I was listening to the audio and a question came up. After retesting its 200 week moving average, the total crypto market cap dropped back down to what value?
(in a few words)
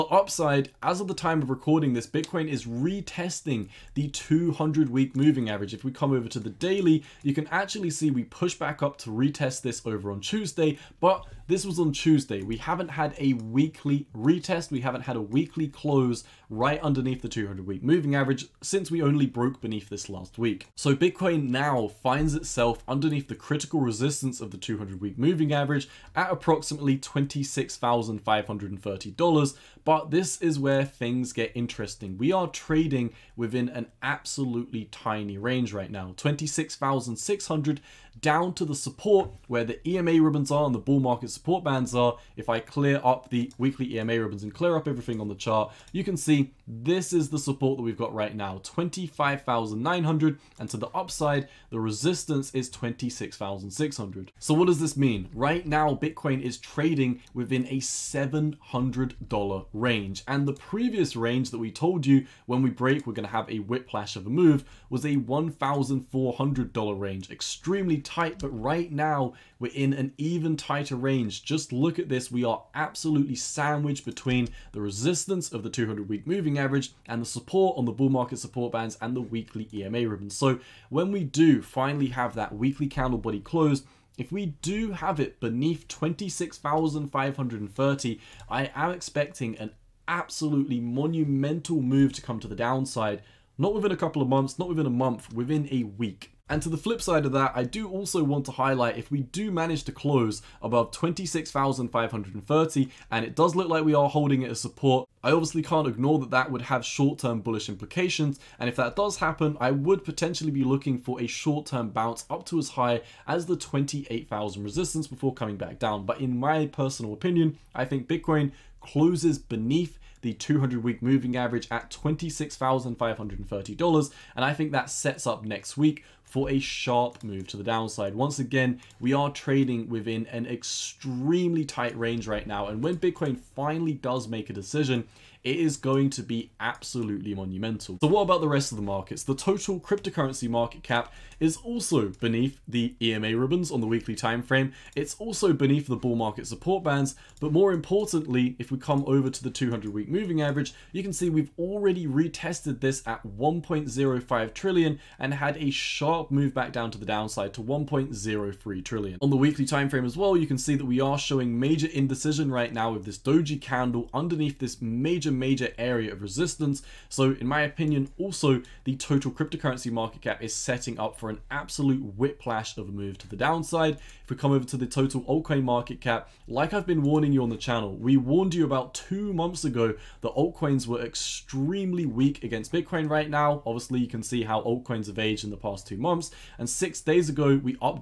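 1.03 trillion.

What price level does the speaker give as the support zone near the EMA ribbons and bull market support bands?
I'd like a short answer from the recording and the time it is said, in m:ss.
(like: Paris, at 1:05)
25,900, at 0:48.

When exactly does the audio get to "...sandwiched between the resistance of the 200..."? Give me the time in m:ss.
1:13.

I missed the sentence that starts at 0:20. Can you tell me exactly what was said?
So Bitcoin now finds itself under underneath the critical resistance of the 200 week moving average at approximately $26,530.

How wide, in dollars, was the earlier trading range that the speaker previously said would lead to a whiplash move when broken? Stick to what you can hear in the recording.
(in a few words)
$1,400.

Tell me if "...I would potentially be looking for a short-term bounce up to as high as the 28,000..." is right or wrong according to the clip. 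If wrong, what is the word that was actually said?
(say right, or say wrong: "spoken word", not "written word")
right.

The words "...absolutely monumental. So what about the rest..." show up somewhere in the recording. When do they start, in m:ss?
2:16.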